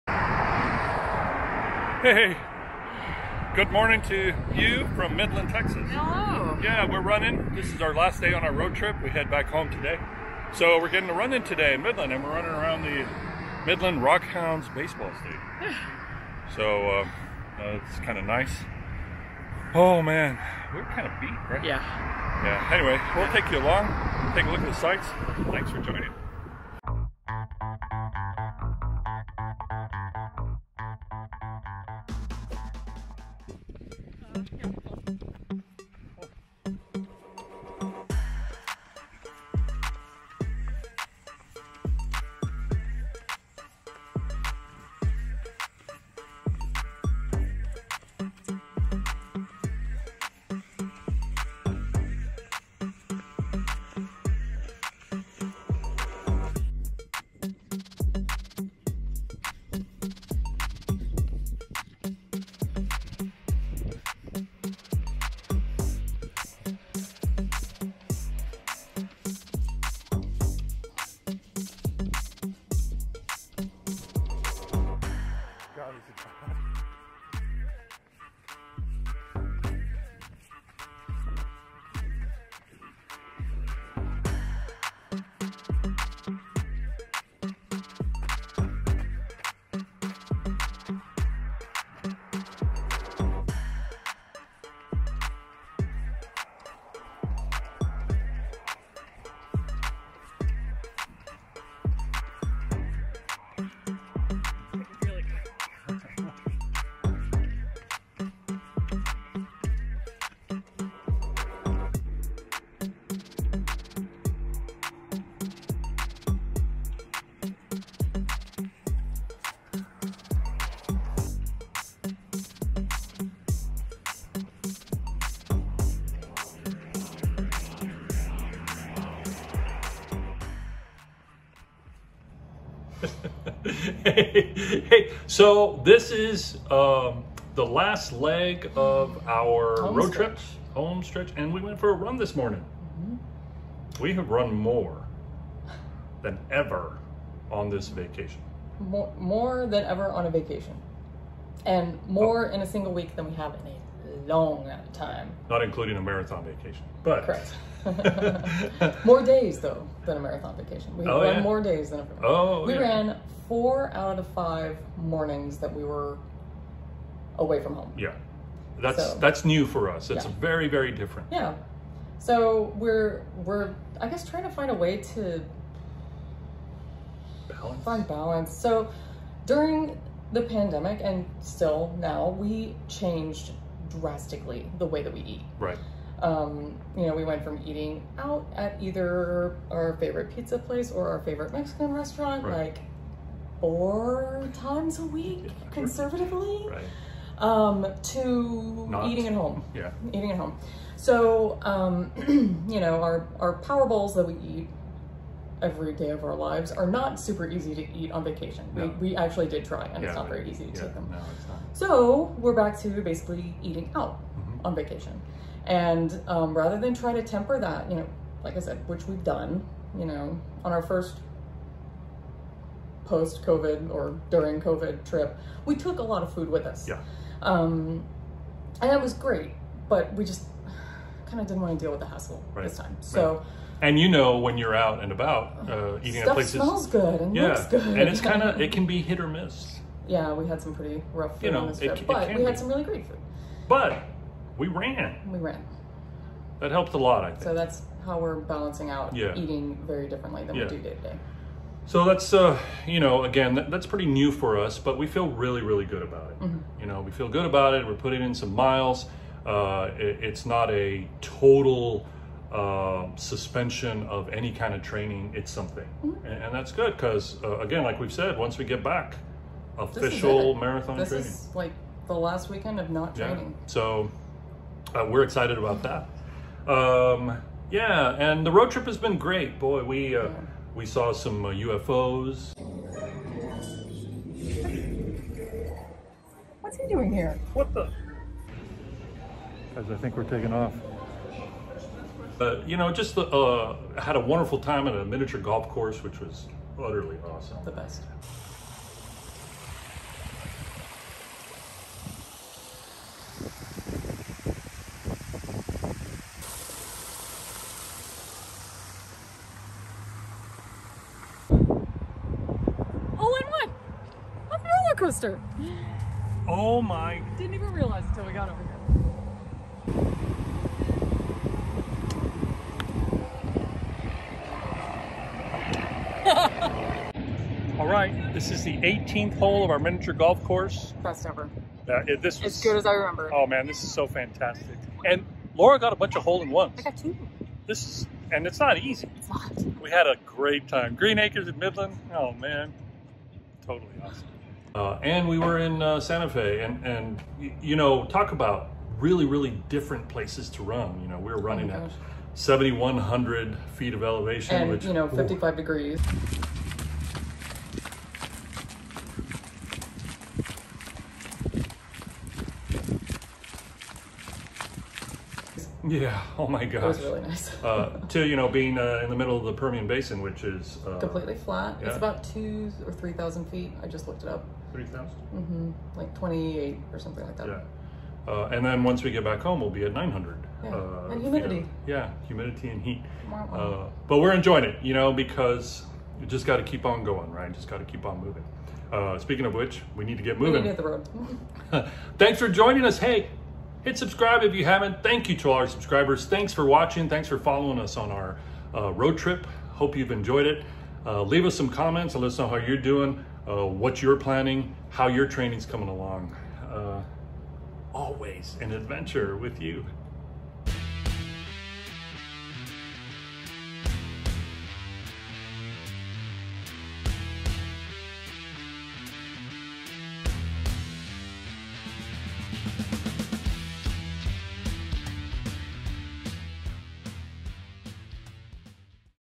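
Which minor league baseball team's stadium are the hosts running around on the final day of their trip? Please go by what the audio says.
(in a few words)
Midland Rockhounds.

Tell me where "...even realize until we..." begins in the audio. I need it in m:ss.
5:17.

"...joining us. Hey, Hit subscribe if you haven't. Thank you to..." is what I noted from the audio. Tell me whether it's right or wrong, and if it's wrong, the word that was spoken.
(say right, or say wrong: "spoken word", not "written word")
right.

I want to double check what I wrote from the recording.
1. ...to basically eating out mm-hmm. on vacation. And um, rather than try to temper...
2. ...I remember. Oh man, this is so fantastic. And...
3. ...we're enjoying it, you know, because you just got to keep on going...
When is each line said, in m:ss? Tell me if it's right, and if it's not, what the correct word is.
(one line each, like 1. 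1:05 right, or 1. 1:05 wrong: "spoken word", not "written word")
1. 3:32 right
2. 5:32 right
3. 6:24 right.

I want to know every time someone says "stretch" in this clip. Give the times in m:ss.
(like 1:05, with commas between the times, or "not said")
2:21.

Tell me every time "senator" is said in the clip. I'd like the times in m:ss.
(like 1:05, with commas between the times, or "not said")
not said.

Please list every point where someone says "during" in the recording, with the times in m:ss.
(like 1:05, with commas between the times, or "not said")
2:59, 3:44.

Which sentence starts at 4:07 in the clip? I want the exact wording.
So that's how we're balancing out yeah.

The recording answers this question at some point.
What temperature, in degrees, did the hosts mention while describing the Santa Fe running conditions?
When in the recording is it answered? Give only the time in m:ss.
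5:55.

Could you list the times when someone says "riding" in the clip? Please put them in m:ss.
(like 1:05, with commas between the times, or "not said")
not said.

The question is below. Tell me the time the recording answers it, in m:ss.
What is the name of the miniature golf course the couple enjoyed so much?
5:40.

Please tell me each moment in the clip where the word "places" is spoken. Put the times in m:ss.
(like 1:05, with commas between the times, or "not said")
3:10, 3:56, 5:50.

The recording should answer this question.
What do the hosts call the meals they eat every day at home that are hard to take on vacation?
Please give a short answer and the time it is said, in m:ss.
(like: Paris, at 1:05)
power bowls, at 3:23.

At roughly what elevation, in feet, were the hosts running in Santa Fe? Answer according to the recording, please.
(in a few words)
7,100 feet.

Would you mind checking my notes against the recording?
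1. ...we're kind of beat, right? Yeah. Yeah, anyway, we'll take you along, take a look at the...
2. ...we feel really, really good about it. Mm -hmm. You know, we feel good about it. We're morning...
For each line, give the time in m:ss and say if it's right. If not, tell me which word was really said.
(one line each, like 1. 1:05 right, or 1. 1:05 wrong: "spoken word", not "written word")
1. 0:20 right
2. 4:14 wrong: "putting", not "morning".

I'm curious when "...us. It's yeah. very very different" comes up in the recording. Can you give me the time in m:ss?
2:49.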